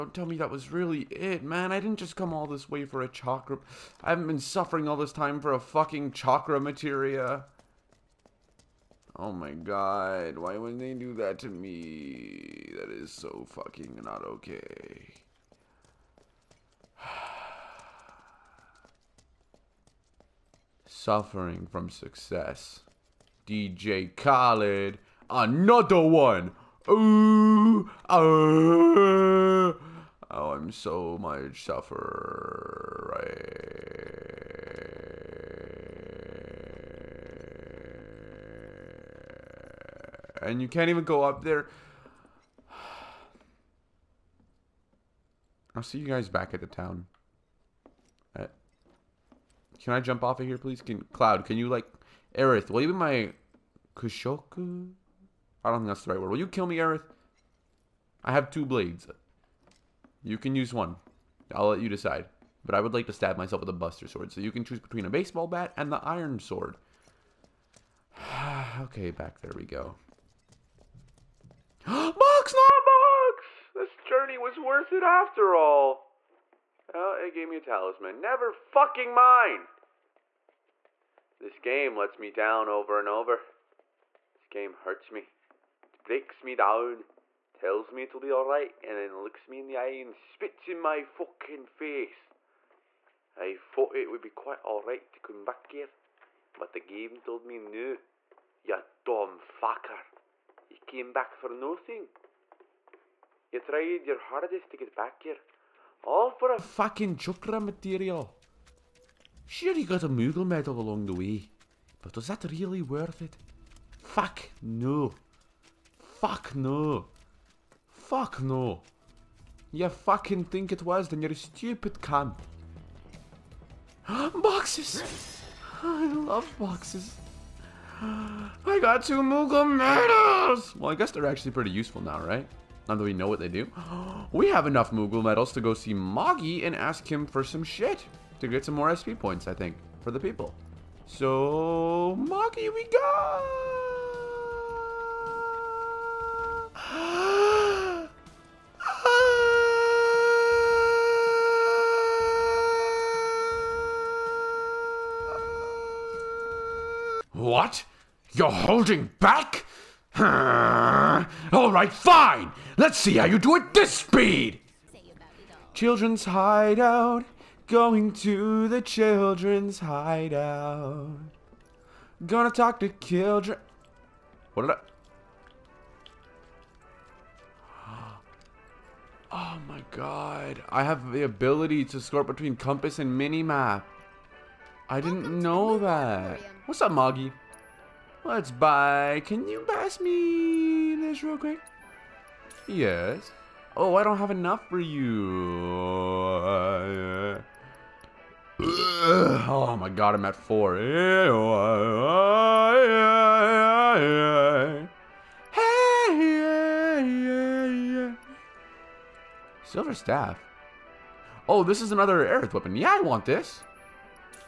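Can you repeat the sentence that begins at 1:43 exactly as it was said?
You tried your hardest to get back here.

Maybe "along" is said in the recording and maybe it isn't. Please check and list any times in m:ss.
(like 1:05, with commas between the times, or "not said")
1:50.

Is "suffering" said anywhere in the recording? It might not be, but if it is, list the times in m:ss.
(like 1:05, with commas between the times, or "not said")
0:04, 0:20, 0:31.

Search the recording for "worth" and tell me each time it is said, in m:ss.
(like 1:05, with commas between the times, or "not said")
1:14, 1:52.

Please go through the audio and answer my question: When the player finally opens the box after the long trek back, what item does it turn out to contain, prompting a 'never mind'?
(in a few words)
Talisman.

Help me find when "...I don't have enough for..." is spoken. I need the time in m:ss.
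3:13.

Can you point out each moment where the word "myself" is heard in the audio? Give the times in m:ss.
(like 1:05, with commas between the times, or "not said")
1:03.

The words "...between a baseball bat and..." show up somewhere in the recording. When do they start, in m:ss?
1:04.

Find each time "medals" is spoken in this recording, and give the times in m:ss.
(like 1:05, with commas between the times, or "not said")
1:50, 2:09, 2:15.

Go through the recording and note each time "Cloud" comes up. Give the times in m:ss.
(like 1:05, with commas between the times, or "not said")
0:51.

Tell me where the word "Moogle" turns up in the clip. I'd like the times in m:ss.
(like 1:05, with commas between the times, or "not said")
1:50, 2:09, 2:14.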